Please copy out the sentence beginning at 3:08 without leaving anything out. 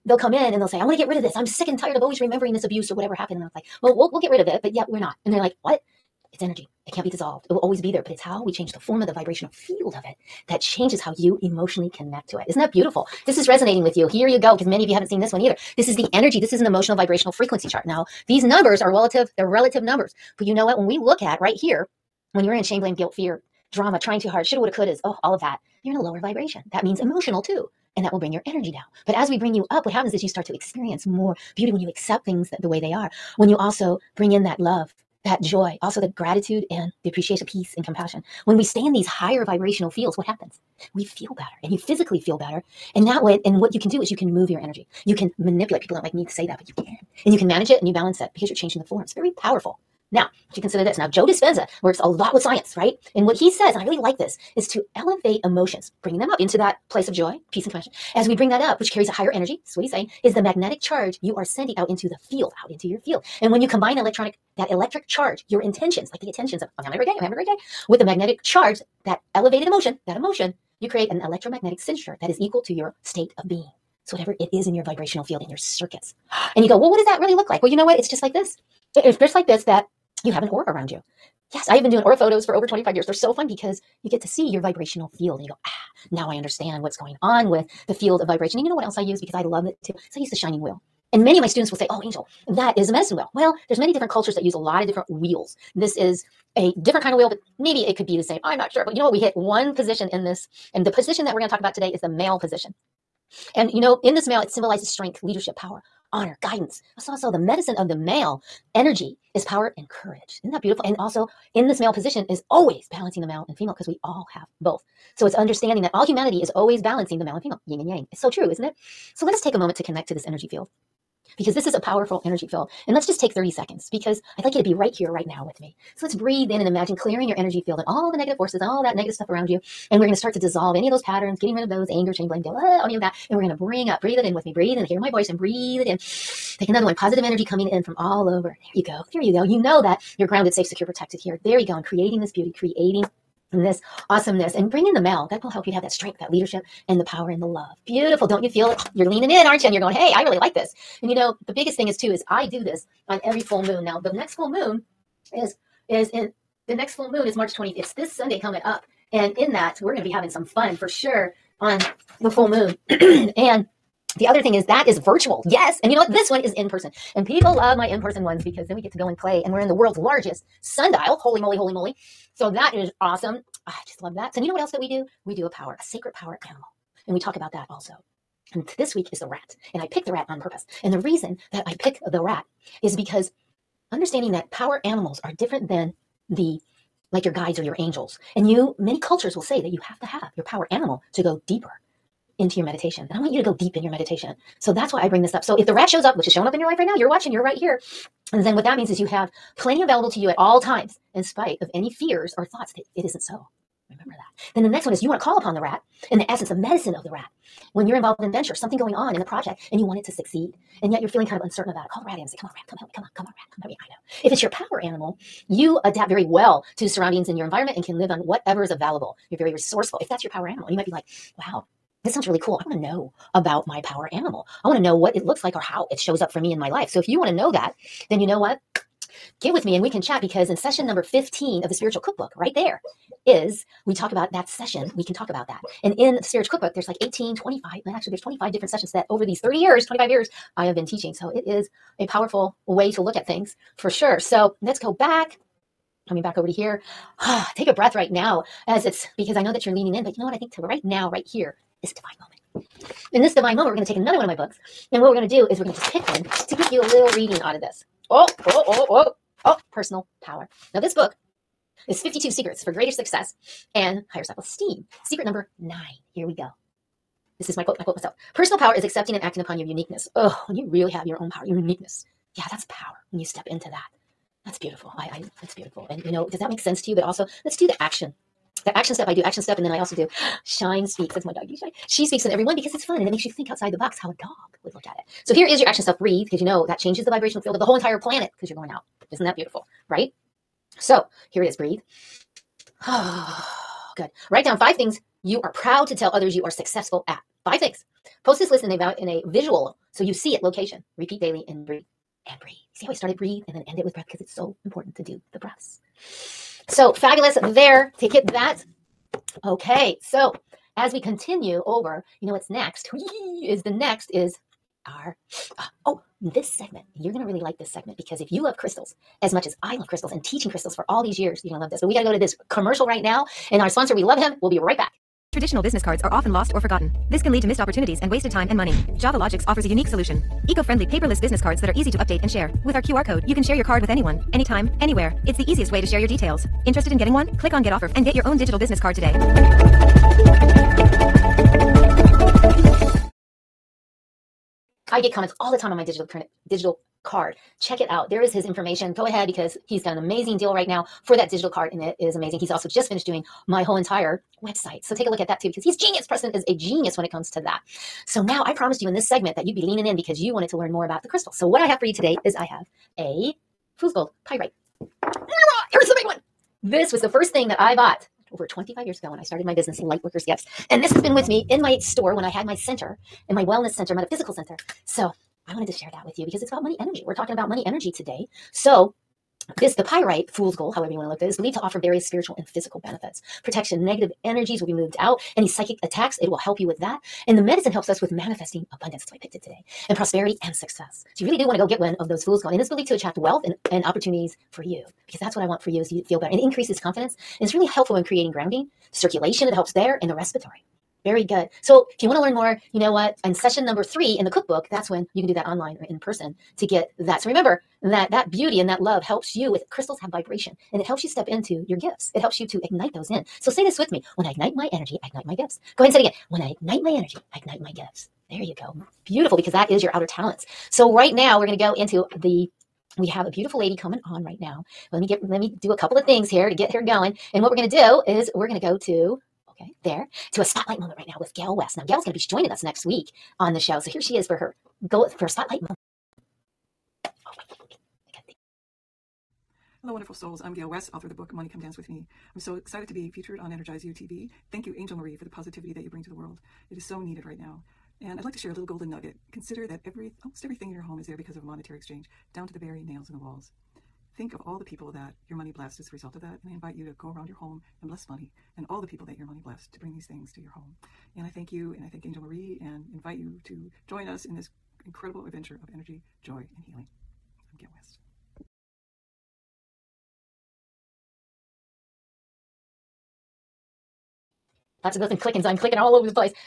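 And you, many cultures will say that you have to have your power animal to go deeper into your meditation.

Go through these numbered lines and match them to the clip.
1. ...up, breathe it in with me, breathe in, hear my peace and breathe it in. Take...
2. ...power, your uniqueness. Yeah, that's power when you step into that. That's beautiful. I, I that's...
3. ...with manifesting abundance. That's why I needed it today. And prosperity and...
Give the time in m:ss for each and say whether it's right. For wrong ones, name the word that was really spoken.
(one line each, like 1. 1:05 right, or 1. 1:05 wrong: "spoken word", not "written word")
1. 2:13 wrong: "voice", not "peace"
2. 4:31 right
3. 6:28 wrong: "picked", not "needed".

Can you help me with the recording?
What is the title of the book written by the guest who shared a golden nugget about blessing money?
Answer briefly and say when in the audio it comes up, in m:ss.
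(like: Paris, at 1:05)
Money Come Dance with Me, at 7:21.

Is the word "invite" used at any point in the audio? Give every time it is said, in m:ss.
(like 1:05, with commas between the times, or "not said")
7:36, 7:42.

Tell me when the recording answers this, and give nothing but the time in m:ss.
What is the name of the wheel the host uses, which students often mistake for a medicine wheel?
1:30.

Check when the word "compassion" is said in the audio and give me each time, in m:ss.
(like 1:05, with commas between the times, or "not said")
0:37, 0:57.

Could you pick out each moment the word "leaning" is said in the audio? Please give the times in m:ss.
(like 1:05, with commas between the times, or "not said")
2:29, 4:09, 5:59.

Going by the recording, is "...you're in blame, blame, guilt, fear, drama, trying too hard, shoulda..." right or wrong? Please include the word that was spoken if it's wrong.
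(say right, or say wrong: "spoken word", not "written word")
wrong: "shame", not "blame".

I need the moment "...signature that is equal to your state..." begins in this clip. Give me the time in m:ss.
1:11.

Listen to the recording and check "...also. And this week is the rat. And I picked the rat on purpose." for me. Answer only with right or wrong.
right.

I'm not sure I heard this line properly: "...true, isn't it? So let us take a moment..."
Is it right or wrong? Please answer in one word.
right.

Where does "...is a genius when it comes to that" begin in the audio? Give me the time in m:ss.
5:56.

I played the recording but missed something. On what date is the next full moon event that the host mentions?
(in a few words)
March 20th.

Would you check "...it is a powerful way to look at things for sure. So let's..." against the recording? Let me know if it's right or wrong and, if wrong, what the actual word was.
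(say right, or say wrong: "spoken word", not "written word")
right.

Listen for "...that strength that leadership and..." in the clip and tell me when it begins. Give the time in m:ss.
2:25.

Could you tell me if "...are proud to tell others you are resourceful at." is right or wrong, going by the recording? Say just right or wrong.
wrong.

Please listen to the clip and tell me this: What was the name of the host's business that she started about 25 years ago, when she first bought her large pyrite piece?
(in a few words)
Lightworkers Gifts.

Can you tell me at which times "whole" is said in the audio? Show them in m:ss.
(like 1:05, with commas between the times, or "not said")
4:47, 5:53.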